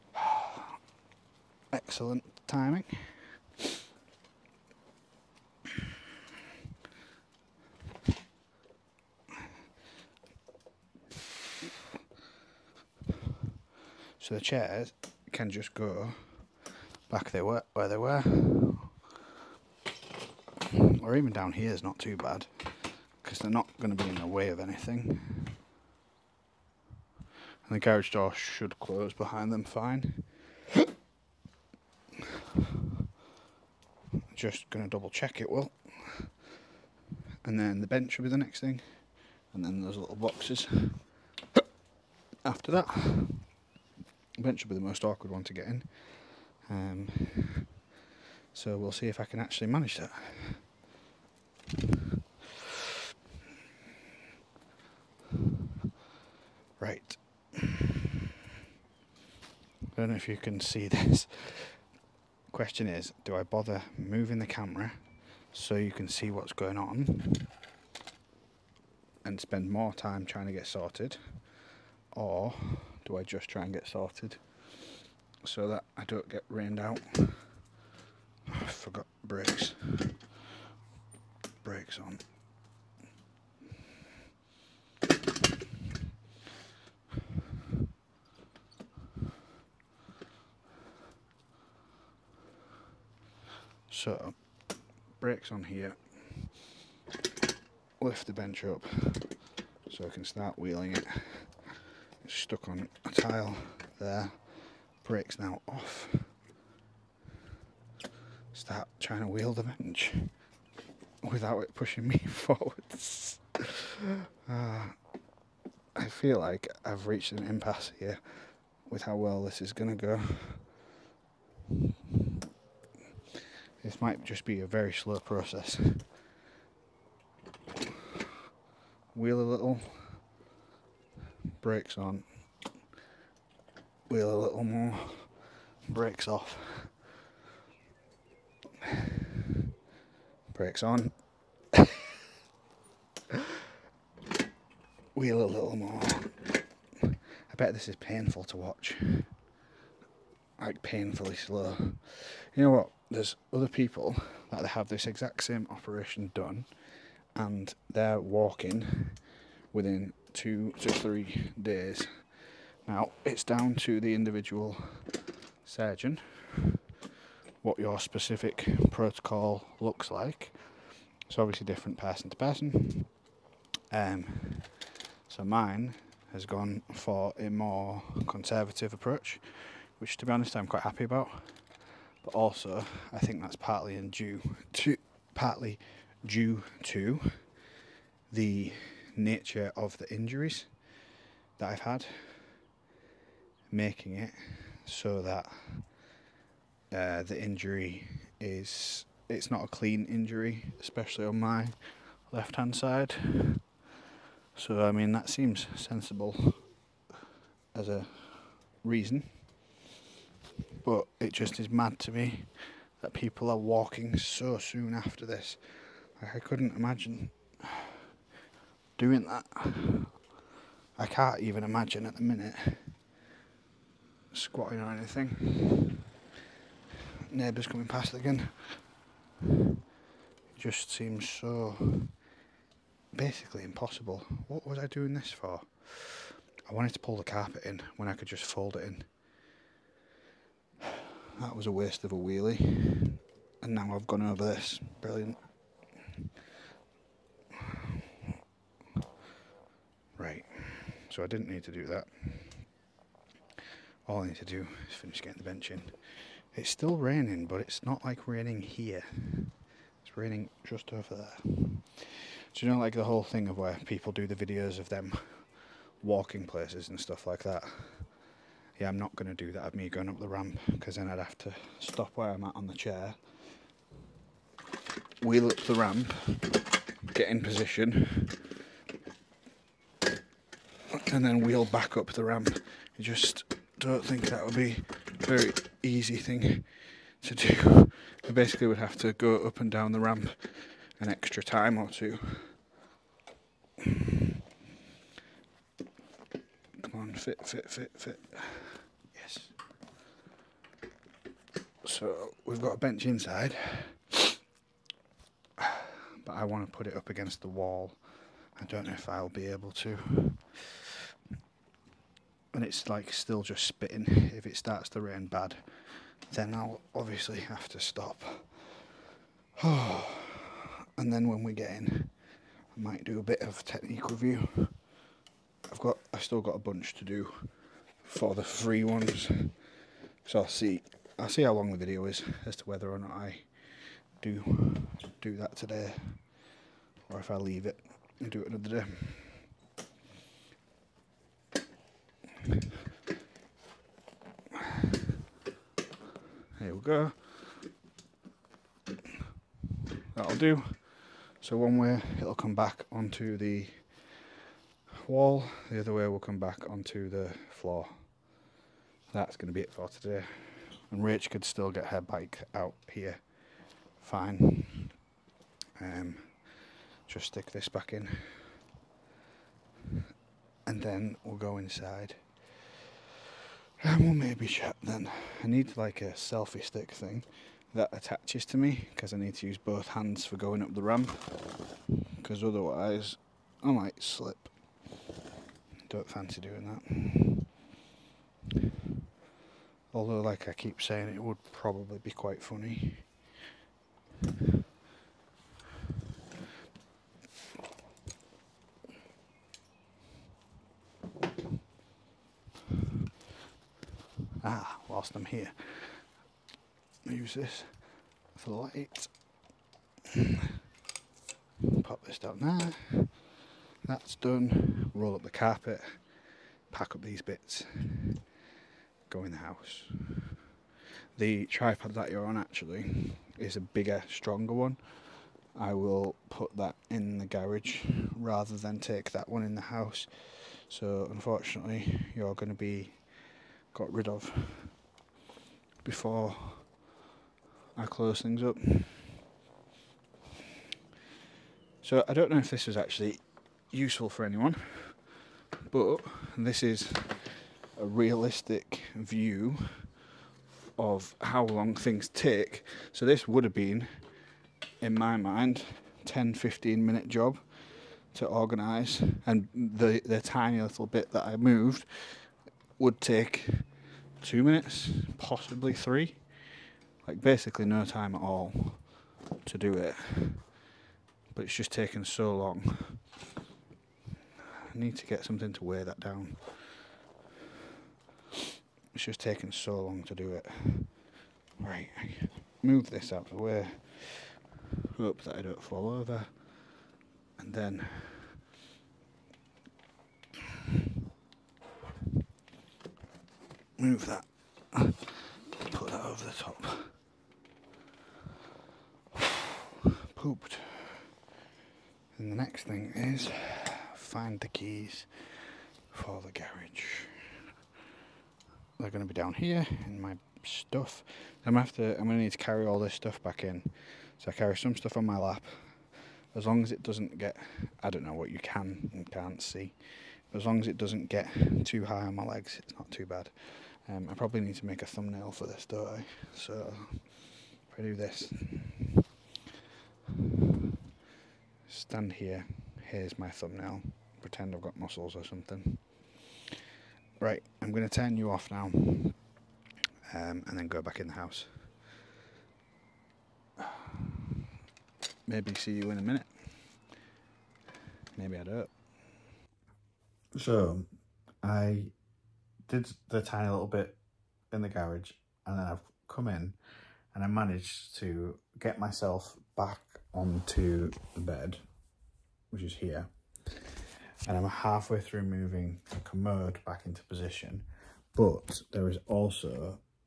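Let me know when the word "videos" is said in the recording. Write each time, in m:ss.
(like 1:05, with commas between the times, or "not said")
4:24, 5:31.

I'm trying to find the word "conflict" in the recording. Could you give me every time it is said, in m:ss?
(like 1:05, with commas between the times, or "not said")
not said.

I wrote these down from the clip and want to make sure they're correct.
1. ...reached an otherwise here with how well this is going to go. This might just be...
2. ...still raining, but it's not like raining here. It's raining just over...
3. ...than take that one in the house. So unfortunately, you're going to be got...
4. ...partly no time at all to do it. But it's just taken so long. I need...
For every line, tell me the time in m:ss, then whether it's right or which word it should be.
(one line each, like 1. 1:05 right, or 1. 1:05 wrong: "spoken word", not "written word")
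1. 1:57 wrong: "impasse", not "otherwise"
2. 4:16 right
3. 7:08 right
4. 7:47 wrong: "basically", not "partly".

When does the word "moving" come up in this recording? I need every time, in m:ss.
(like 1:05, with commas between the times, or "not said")
1:03, 9:25.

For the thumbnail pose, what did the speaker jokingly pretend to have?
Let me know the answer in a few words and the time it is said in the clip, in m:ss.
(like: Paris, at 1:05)
Muscles, at 8:54.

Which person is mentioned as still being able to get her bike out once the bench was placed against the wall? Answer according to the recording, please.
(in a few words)
Rach.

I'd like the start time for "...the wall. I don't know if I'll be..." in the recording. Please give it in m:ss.
5:07.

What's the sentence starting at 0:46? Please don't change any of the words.
Um, so we'll see if I can actually manage that.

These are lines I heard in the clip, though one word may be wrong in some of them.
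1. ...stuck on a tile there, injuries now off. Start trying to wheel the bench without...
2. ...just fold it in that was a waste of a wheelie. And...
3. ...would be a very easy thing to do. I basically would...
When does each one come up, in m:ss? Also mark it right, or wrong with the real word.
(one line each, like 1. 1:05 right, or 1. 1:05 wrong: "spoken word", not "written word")
1. 1:42 wrong: "brakes", not "injuries"
2. 3:58 right
3. 4:44 right.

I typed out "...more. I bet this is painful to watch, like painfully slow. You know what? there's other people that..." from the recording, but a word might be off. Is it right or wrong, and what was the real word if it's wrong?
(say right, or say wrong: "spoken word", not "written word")
right.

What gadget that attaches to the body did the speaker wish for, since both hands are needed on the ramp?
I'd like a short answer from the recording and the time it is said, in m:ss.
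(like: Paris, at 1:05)
Selfie stick, at 6:16.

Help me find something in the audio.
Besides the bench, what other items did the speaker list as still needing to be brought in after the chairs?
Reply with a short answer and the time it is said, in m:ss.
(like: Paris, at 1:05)
Little boxes, at 0:39.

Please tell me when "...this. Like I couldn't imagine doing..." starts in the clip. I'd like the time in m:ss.
3:35.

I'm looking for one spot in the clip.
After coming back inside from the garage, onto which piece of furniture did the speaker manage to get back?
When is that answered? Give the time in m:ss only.
9:21.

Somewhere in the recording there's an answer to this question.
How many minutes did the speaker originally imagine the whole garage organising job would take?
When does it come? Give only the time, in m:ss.
7:36.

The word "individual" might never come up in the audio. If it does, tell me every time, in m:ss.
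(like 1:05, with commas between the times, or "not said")
2:44.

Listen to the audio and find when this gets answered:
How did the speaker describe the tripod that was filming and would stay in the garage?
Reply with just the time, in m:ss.
7:03.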